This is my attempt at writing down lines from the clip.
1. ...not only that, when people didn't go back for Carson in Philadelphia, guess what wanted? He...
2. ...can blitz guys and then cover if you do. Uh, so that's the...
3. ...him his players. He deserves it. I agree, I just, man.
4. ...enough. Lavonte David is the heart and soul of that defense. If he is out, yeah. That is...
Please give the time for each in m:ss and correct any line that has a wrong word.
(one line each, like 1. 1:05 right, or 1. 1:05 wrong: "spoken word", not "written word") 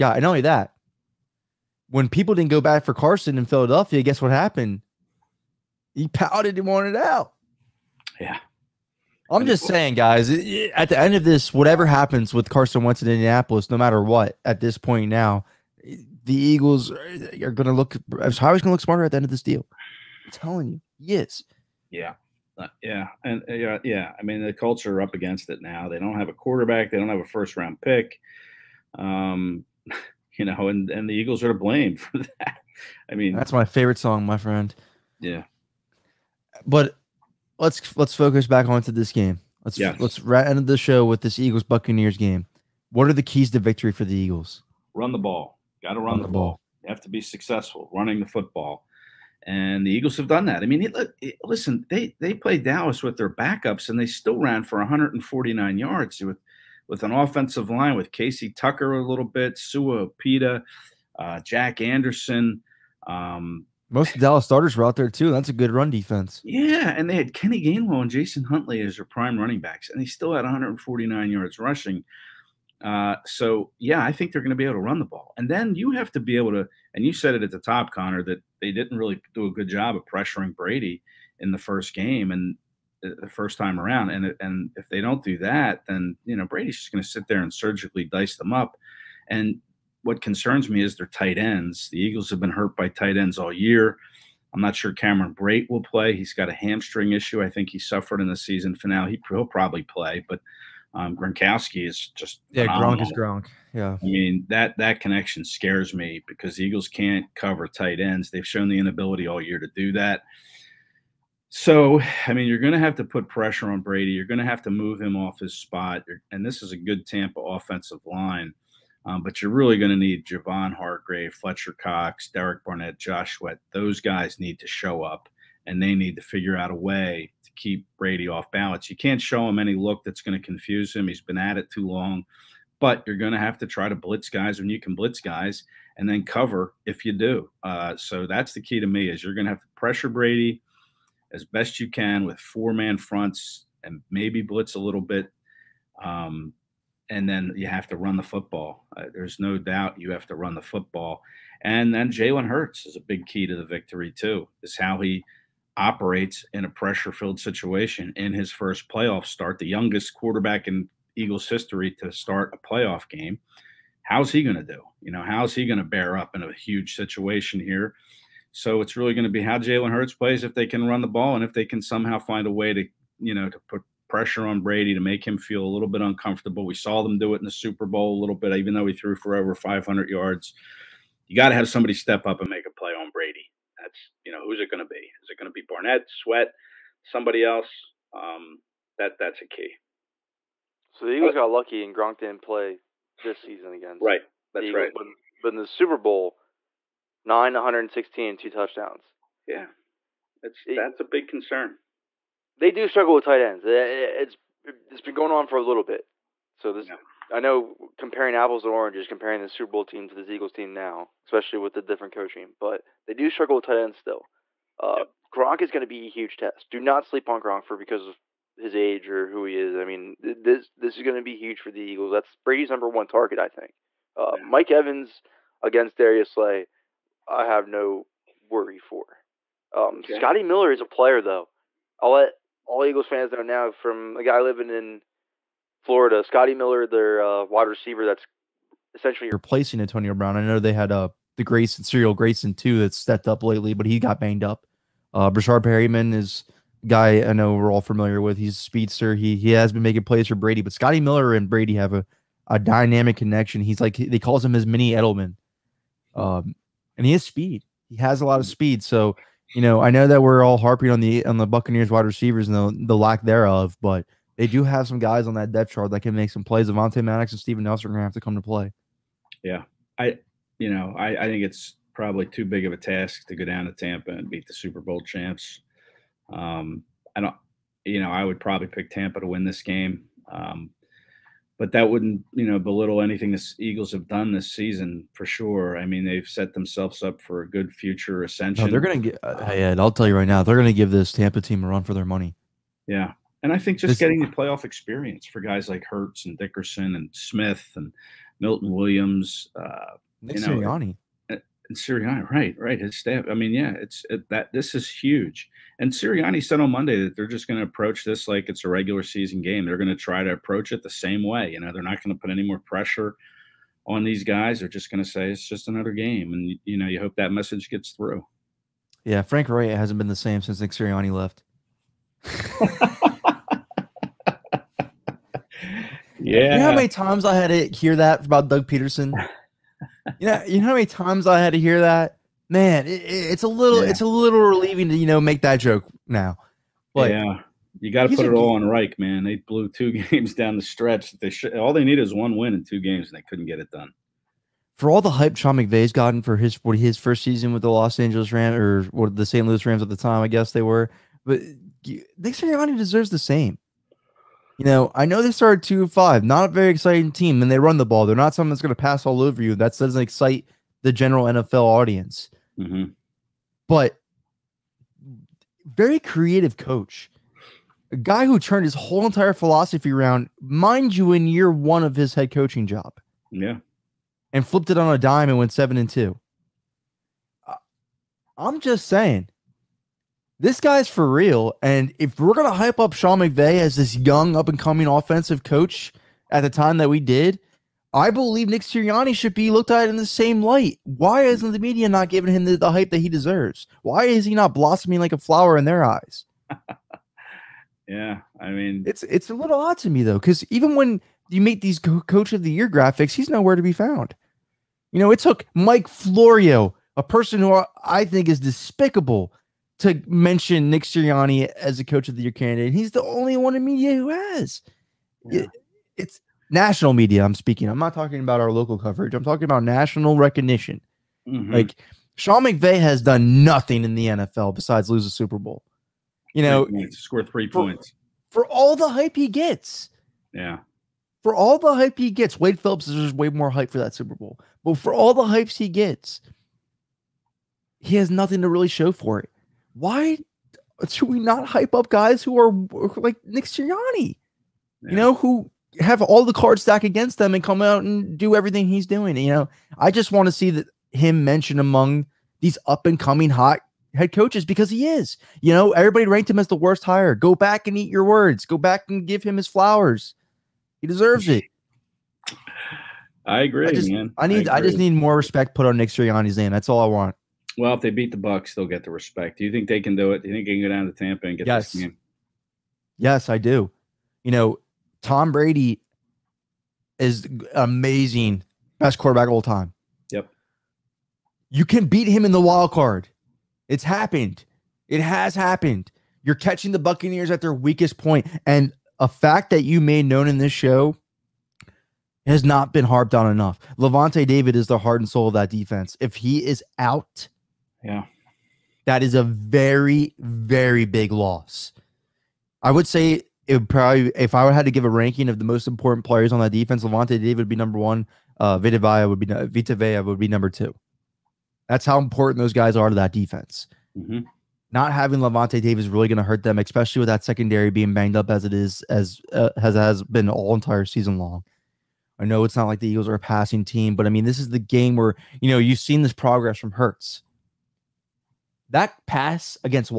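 1. 0:00 wrong: "happened", not "wanted"
2. 2:14 right
3. 7:39 wrong: "flowers", not "players"
4. 8:13 right.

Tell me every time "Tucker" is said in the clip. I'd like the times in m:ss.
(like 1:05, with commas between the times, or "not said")
0:58.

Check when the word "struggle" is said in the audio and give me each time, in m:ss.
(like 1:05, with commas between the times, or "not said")
3:22, 3:33.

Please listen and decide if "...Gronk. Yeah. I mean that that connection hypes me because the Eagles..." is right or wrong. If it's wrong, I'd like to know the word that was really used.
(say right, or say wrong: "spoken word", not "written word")
wrong: "scares", not "hypes".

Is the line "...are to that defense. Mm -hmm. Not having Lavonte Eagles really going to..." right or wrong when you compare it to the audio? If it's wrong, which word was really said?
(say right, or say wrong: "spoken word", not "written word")
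wrong: "Davis", not "Eagles".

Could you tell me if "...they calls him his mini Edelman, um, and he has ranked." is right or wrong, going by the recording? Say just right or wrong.
wrong.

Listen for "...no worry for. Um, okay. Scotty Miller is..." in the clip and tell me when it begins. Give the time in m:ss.
3:47.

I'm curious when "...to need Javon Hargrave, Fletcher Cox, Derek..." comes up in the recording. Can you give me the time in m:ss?
1:59.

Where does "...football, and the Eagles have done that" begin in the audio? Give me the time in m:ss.
0:48.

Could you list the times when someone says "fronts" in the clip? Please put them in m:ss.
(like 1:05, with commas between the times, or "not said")
2:22.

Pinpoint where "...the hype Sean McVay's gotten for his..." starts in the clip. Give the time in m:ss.
5:45.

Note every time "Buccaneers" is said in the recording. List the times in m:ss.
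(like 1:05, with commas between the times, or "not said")
0:41, 4:21, 8:06.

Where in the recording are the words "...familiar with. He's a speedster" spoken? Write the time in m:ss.
4:07.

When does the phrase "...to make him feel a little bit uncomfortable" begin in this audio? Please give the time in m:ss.
2:54.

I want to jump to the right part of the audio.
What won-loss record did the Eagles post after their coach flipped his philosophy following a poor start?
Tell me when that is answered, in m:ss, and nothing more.
6:15.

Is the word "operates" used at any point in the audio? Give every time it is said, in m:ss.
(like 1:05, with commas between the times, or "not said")
2:35.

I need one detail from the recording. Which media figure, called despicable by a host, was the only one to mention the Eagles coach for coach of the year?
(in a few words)
Mike Florio.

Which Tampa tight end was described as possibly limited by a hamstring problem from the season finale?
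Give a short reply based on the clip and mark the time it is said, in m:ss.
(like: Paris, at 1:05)
Cameron Brate, at 1:34.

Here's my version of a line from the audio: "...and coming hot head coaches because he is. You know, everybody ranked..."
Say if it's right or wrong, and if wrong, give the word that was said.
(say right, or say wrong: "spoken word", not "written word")
right.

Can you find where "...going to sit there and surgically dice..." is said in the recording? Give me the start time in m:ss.
1:26.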